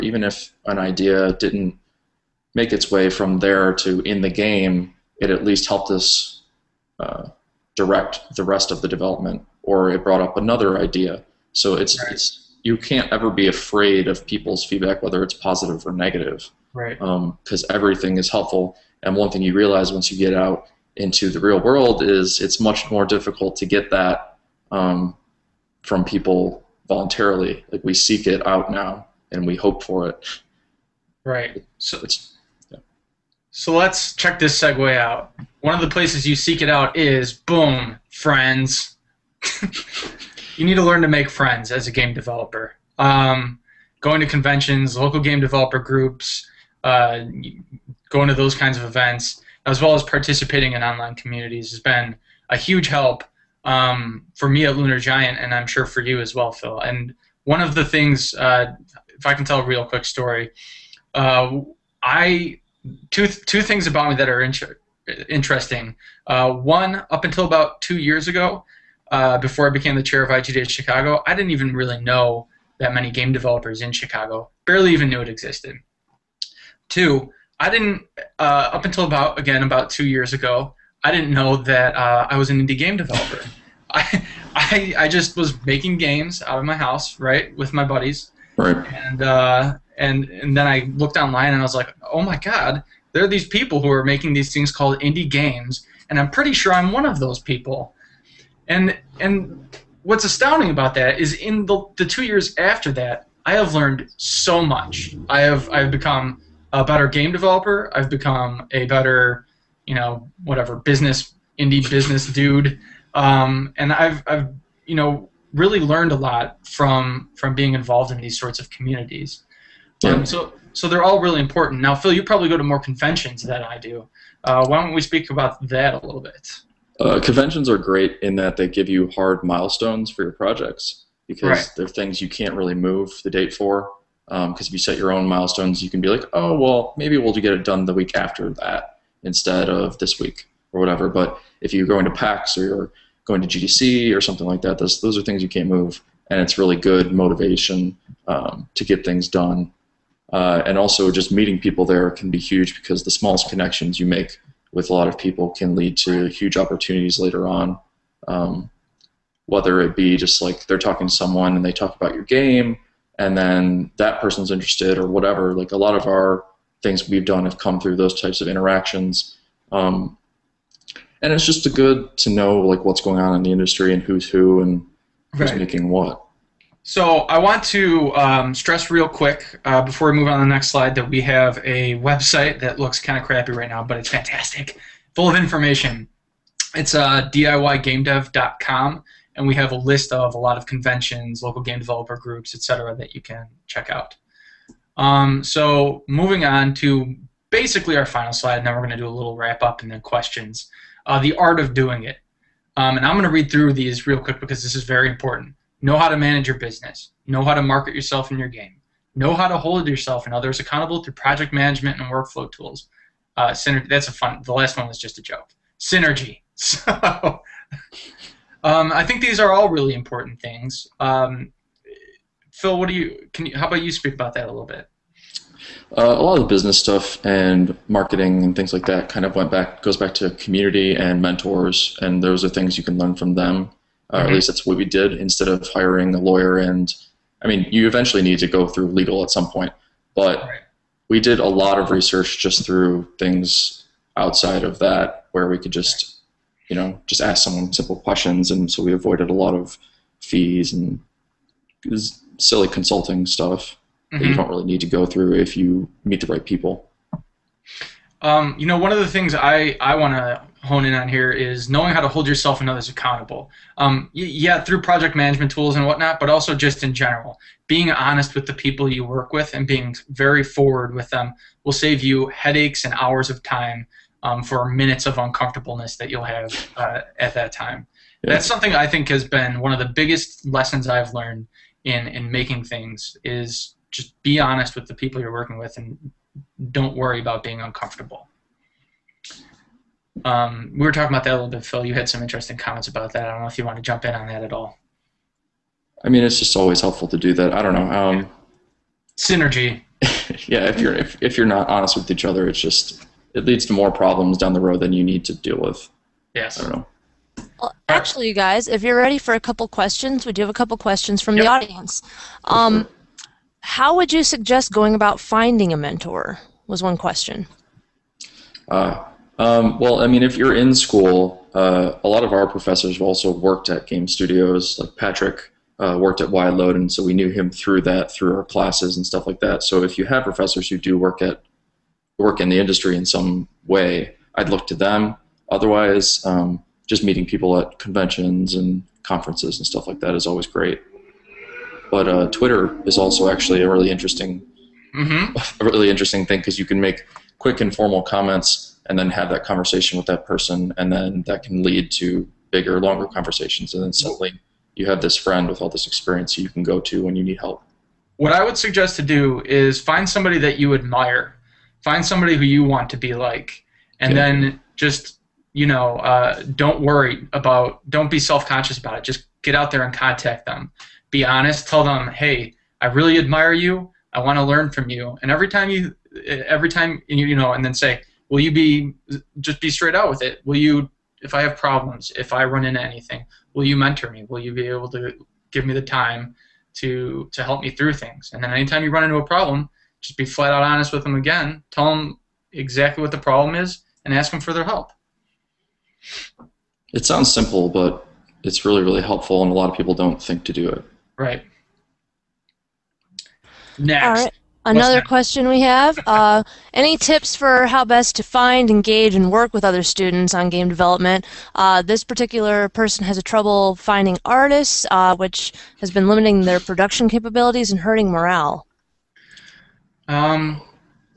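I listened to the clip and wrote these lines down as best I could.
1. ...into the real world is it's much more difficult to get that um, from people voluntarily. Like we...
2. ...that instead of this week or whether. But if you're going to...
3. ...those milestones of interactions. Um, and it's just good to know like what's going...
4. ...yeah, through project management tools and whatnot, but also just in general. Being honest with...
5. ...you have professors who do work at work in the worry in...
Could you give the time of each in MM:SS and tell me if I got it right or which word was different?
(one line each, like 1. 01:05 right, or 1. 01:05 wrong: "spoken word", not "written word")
1. 00:20 right
2. 02:18 wrong: "whatever", not "whether"
3. 02:47 wrong: "types", not "milestones"
4. 04:24 right
5. 05:29 wrong: "industry", not "worry".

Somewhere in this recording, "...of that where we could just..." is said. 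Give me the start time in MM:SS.
04:04.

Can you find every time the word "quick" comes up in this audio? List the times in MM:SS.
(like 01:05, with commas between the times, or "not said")
00:59, 02:59, 03:24, 05:47.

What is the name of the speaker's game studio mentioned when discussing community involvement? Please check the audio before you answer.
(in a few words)
Lunar Giant.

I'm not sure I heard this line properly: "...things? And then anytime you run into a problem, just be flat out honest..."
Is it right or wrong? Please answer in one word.
right.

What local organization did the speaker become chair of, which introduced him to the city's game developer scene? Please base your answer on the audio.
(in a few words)
IGDA Chicago.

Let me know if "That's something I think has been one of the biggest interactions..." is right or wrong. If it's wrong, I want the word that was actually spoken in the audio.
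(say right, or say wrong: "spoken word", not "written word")
wrong: "lessons", not "interactions".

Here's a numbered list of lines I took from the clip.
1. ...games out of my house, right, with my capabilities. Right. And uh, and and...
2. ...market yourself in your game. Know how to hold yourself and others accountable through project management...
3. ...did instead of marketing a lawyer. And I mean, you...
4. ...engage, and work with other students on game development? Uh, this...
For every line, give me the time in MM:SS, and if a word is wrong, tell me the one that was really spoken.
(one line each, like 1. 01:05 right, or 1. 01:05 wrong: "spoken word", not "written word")
1. 01:25 wrong: "buddies", not "capabilities"
2. 03:27 right
3. 03:54 wrong: "hiring", not "marketing"
4. 06:48 right.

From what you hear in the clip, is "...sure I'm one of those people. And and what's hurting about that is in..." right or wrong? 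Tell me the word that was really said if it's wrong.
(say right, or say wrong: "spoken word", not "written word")
wrong: "astounding", not "hurting".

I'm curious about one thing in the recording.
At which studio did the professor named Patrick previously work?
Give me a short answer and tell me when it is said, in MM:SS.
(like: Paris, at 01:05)
Wideload, at 05:26.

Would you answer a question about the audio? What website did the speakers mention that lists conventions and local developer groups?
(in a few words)
DIYGameDev.com.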